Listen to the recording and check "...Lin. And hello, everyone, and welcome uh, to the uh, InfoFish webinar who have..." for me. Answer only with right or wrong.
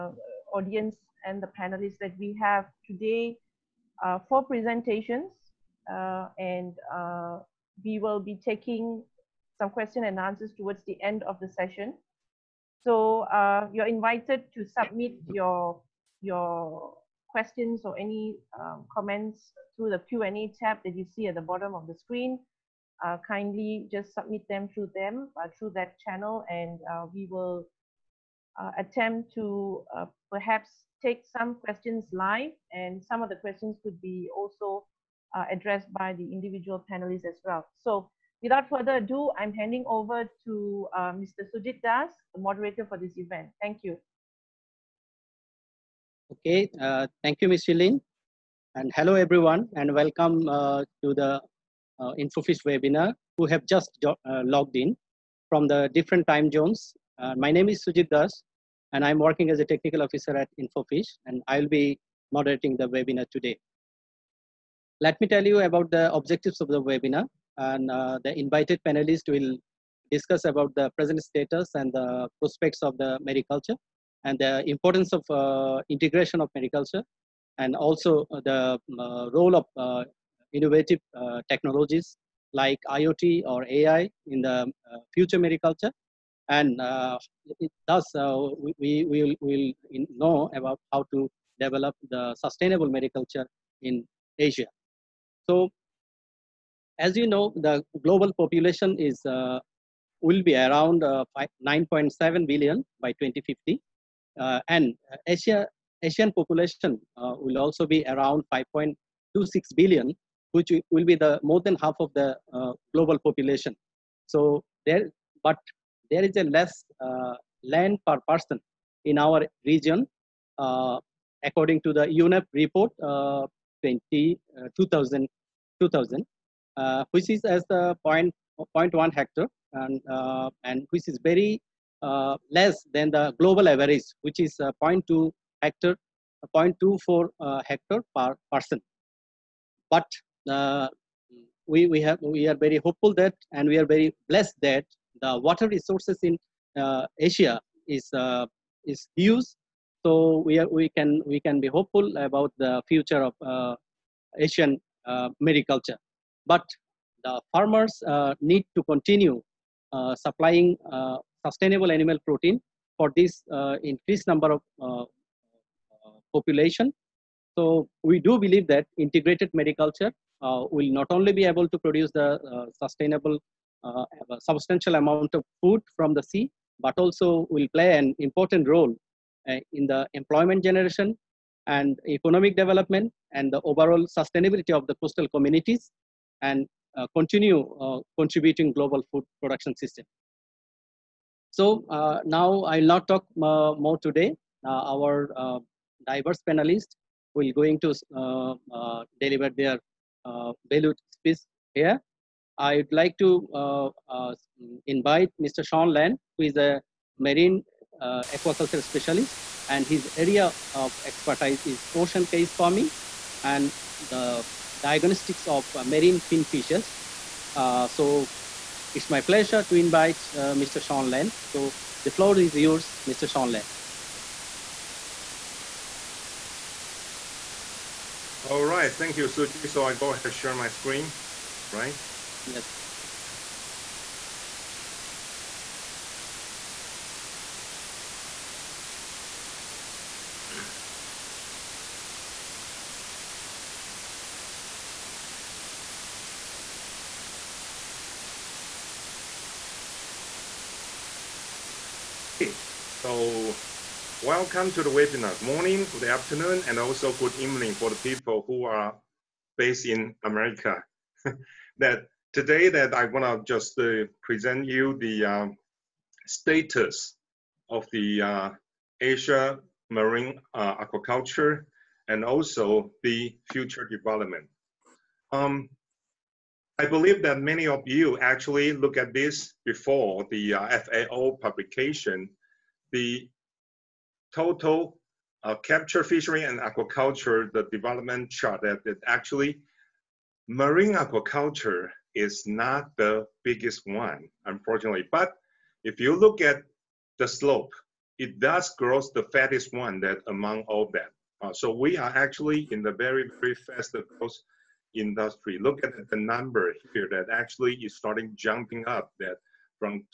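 right.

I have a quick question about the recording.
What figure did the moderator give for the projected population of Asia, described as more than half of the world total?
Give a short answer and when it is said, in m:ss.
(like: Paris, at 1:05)
5.26 billion, at 1:48.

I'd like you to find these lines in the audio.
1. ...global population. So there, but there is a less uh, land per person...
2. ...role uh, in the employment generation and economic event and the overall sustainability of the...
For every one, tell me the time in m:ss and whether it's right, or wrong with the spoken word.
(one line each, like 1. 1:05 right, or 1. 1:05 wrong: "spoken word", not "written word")
1. 1:52 right
2. 2:58 wrong: "development", not "event".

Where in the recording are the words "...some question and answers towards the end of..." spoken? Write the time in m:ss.
0:09.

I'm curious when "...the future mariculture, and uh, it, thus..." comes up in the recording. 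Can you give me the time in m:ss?
1:24.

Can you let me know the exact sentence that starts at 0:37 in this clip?
So without further ado, I'm handing over to Mr.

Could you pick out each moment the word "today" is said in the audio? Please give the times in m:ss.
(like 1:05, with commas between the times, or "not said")
0:02, 1:03, 3:14, 4:22.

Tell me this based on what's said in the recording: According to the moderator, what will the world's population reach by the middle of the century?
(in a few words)
9.7 billion.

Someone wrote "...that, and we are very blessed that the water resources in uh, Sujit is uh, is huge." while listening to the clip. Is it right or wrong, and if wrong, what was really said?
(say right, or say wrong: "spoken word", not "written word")
wrong: "Asia", not "Sujit".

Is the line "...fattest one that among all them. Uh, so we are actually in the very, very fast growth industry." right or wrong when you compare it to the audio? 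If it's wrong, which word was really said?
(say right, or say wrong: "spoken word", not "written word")
right.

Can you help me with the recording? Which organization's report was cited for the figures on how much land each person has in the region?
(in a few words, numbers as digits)
UNEP.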